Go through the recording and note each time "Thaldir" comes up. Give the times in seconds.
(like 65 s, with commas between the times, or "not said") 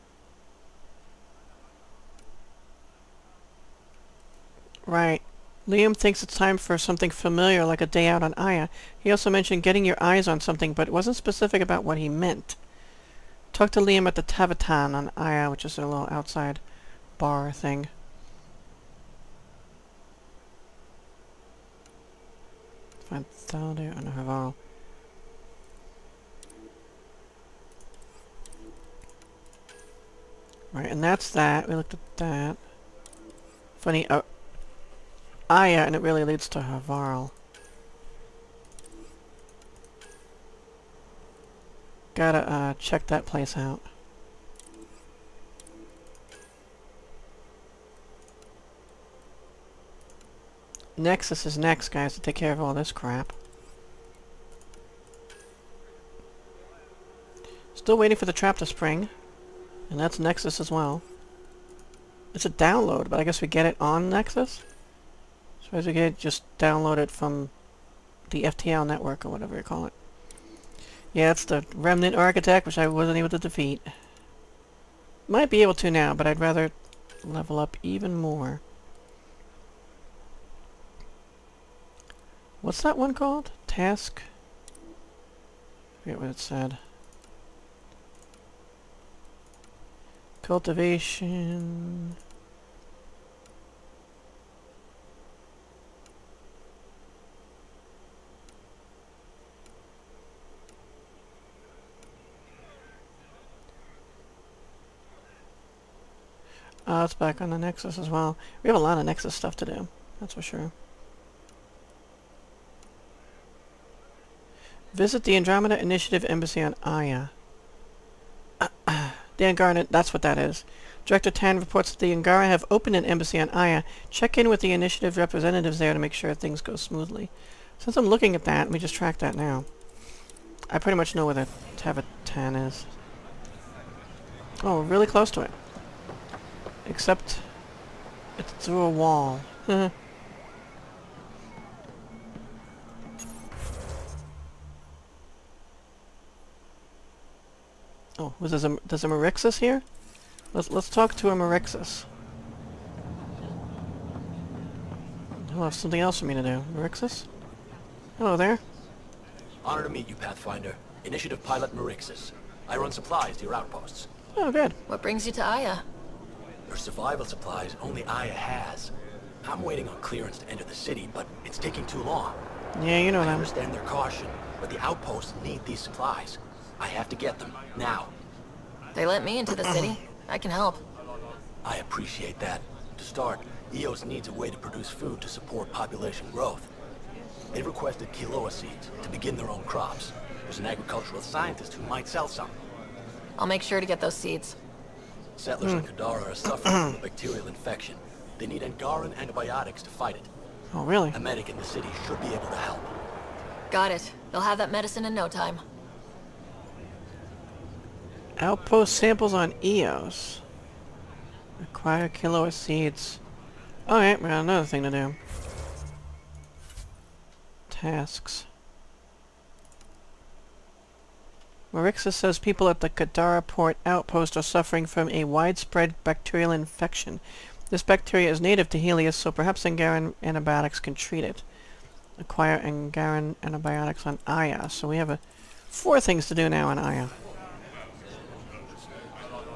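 23 s.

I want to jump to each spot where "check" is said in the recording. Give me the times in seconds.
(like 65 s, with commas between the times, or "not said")
42 s, 124 s.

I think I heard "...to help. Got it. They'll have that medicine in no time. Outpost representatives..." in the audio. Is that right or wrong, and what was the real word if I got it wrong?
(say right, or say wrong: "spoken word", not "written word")
wrong: "samples", not "representatives".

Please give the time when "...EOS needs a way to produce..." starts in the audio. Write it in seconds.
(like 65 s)
183 s.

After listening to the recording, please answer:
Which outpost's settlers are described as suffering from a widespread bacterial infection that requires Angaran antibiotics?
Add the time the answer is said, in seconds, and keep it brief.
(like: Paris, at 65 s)
Kadara port, at 222 s.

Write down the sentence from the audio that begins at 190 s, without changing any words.
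There's an agricultural scientist who might sell some.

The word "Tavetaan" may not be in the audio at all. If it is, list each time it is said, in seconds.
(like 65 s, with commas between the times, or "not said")
14 s, 131 s.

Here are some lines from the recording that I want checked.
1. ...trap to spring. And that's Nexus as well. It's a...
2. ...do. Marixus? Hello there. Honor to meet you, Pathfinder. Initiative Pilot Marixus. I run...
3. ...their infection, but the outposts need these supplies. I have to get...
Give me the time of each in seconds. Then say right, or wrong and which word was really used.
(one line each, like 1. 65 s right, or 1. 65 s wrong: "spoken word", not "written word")
1. 58 s right
2. 156 s right
3. 173 s wrong: "caution", not "infection".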